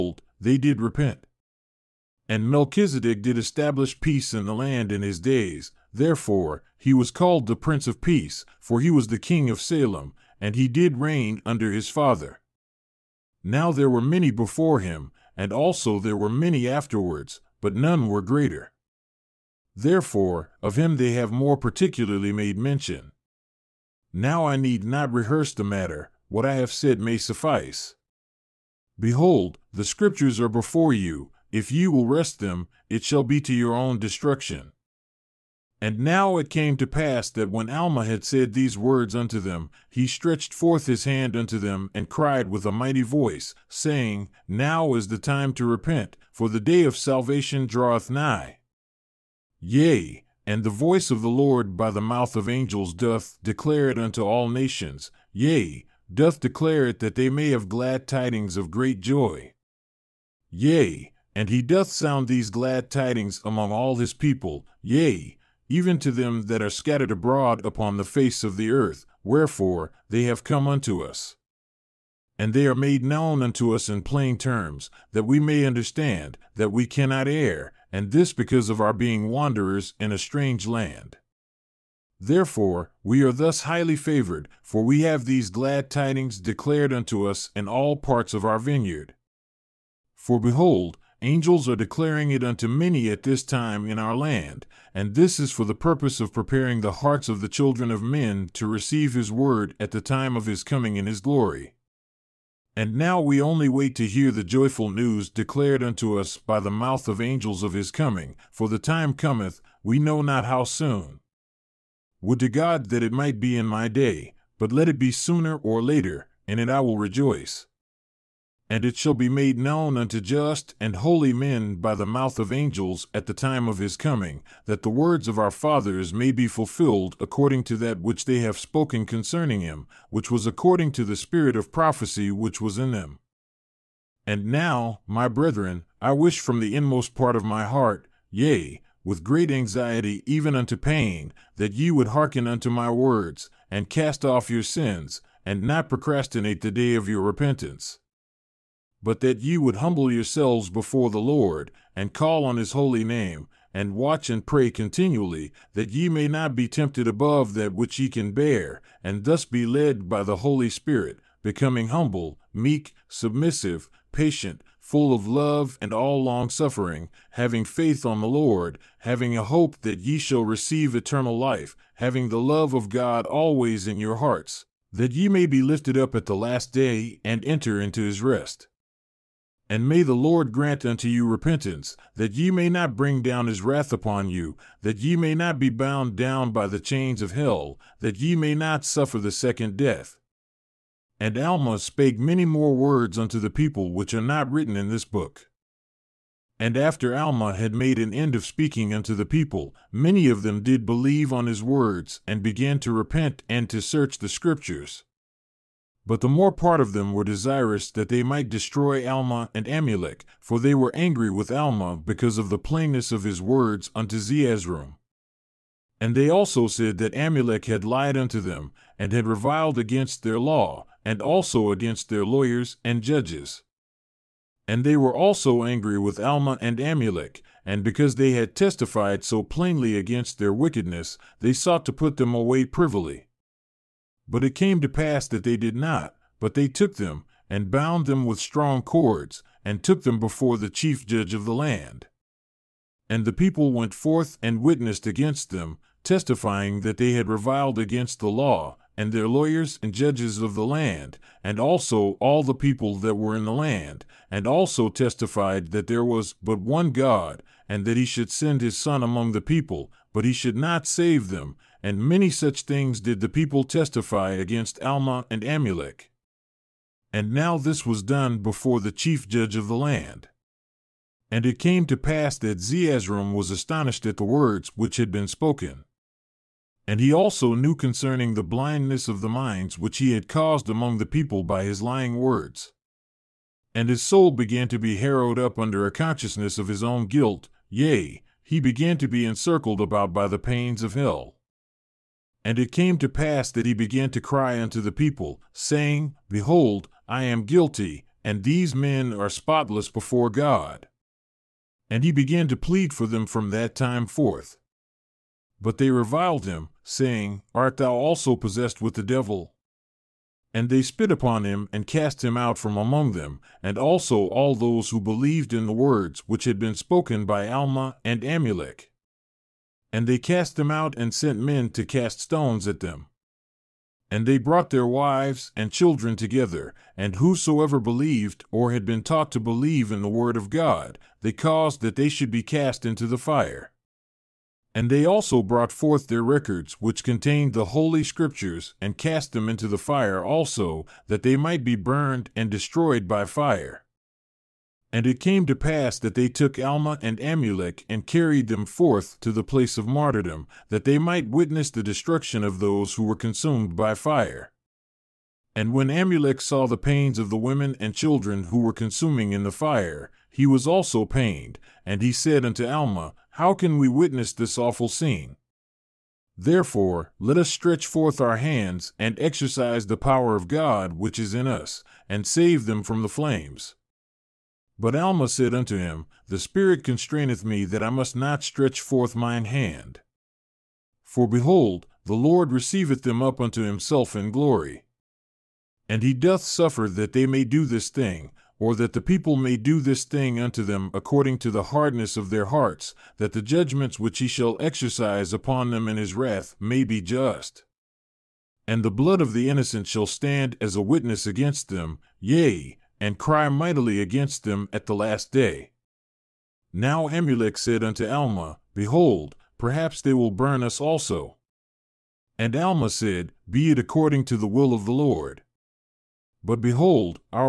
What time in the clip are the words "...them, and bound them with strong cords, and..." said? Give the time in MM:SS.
03:56.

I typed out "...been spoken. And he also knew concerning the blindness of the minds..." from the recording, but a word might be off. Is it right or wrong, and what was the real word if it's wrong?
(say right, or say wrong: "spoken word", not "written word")
right.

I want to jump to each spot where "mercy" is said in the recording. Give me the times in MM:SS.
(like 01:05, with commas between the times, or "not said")
not said.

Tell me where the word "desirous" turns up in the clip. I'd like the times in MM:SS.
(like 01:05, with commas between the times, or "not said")
03:27.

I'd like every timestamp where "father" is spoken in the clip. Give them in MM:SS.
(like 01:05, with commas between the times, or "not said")
00:11, 02:05.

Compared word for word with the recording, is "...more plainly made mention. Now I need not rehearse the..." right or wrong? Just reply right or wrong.
wrong.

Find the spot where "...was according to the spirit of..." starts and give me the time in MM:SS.
02:10.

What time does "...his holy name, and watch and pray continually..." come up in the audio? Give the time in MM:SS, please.
02:32.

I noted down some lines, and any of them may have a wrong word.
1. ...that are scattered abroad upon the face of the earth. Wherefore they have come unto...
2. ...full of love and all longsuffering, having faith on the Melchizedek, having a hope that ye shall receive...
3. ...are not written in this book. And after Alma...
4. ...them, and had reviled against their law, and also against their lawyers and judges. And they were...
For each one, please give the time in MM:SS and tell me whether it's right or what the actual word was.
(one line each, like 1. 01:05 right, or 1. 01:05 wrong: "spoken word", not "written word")
1. 01:06 right
2. 02:44 wrong: "Lord", not "Melchizedek"
3. 03:14 right
4. 03:38 right.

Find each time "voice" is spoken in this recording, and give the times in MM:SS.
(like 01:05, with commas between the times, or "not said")
00:43, 00:50.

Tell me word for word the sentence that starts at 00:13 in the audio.
Now there were many before him, and also there were many afterwards, but none were greater.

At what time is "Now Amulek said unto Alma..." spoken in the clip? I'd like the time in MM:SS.
06:46.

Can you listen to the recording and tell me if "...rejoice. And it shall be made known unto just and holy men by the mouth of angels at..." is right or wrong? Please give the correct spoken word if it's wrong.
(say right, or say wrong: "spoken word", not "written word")
right.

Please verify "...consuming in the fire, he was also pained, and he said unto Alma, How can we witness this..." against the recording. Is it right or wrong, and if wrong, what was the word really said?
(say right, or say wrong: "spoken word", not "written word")
right.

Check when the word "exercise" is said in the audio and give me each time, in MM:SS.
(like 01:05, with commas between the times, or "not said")
06:09, 06:34.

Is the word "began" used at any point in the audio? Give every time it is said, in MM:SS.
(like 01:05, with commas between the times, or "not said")
03:22, 04:44, 04:48, 04:53, 05:02.